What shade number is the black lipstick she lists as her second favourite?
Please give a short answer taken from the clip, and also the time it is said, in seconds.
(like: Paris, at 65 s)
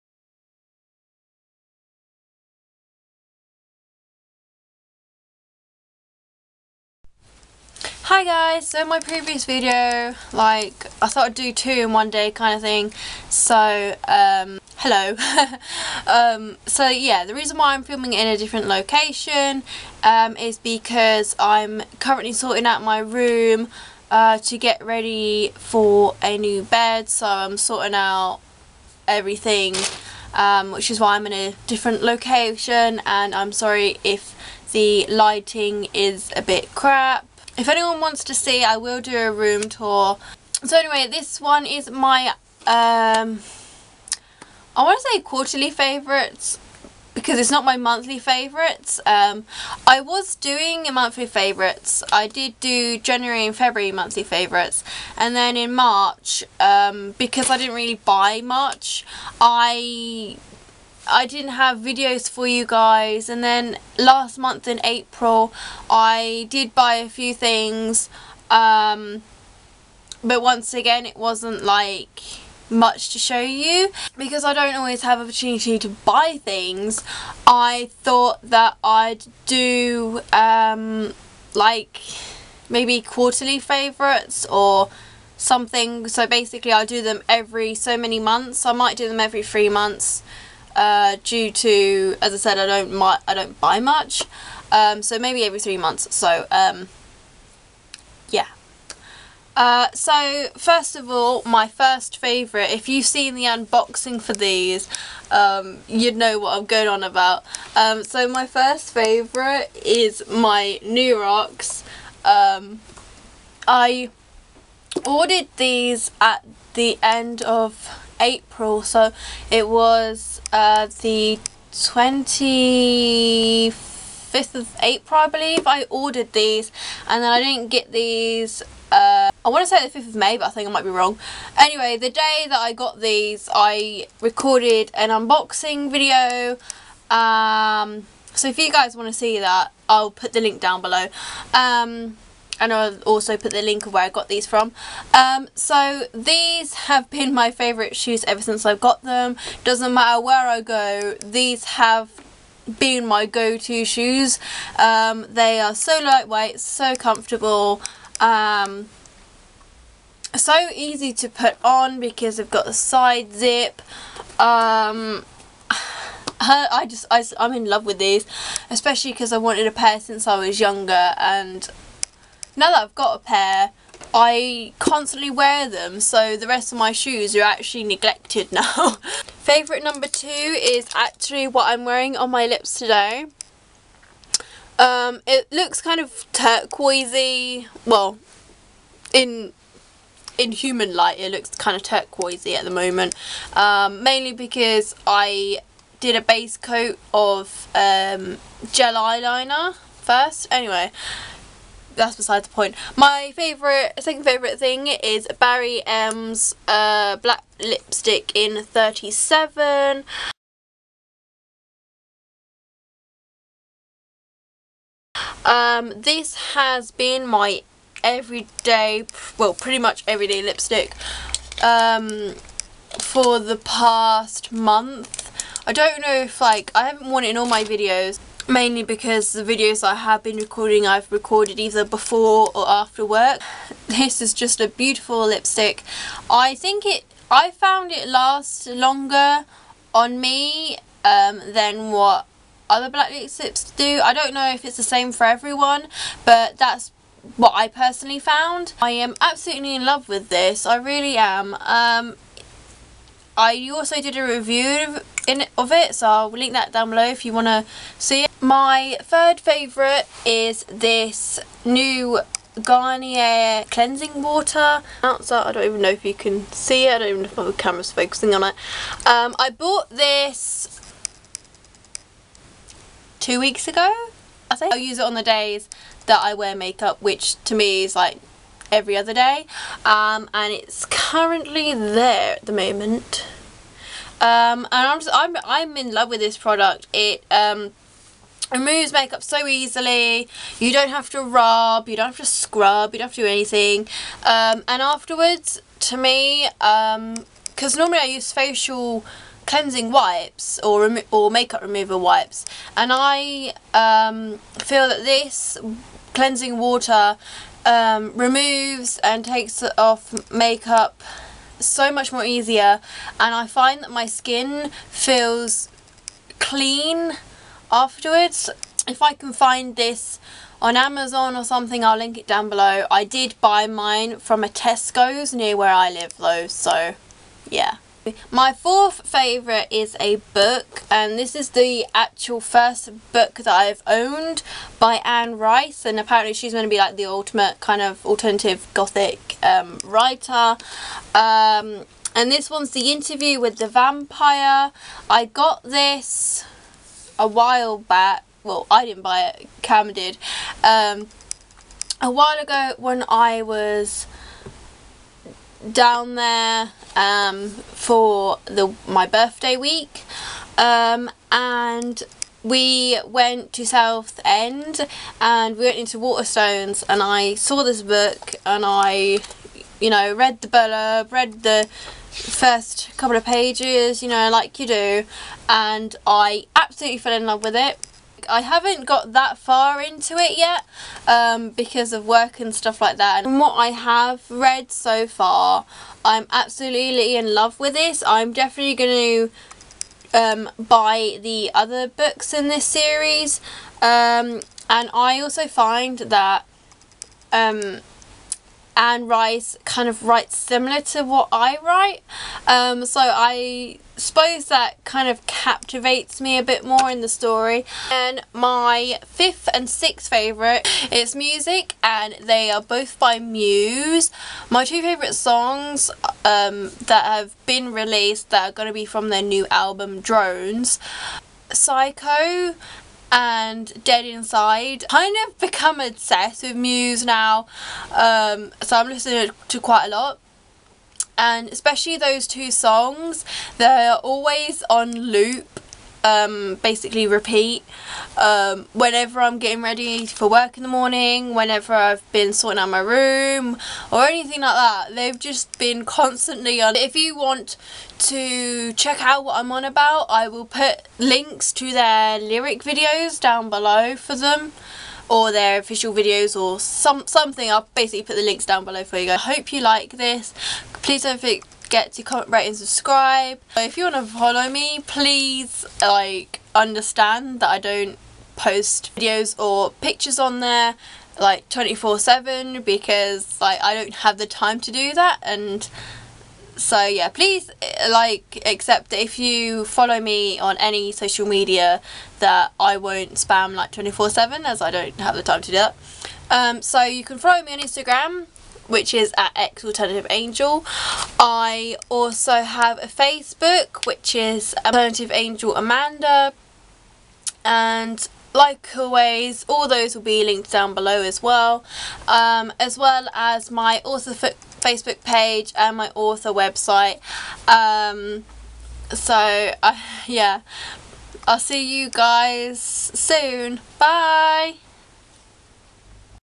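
37, at 208 s.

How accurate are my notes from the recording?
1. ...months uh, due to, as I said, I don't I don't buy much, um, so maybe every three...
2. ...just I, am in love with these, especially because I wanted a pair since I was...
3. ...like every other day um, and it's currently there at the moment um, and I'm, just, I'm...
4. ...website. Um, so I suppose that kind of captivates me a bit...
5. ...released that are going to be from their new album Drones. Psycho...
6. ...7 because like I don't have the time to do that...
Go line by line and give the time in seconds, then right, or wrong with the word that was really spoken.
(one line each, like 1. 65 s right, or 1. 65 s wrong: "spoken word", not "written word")
1. 89 s right
2. 166 s right
3. 277 s right
4. 401 s wrong: "write", not "website"
5. 417 s right
6. 471 s right.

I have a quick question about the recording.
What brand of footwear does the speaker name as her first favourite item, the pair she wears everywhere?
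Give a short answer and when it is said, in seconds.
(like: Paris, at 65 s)
New Rocks, at 110 s.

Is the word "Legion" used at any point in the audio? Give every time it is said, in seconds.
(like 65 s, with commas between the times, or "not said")
not said.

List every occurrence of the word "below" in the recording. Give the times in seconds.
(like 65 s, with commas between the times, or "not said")
140 s, 256 s, 322 s, 453 s, 458 s, 500 s.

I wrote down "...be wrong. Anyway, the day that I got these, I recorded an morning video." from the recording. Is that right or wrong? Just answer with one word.
wrong.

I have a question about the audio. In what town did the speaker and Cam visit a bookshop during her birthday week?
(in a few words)
Southend.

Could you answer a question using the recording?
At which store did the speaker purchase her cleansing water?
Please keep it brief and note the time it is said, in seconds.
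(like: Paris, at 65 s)
Tesco, at 324 s.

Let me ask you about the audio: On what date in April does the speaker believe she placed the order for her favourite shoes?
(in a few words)
25th of April.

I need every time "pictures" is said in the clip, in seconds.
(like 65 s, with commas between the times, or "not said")
469 s.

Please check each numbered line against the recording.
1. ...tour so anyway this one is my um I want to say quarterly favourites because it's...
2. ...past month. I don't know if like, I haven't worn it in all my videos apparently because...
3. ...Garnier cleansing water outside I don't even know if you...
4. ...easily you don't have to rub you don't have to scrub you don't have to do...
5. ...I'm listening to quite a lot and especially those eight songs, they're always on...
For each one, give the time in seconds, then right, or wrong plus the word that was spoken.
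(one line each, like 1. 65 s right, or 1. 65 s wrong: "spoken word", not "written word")
1. 39 s right
2. 223 s wrong: "mainly", not "apparently"
3. 262 s right
4. 289 s right
5. 428 s wrong: "two", not "eight".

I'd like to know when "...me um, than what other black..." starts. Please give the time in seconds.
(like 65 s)
240 s.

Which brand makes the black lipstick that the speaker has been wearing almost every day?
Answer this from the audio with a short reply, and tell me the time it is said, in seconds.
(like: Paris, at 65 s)
Barry M, at 205 s.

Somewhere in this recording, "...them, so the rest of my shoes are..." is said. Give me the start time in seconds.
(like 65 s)
175 s.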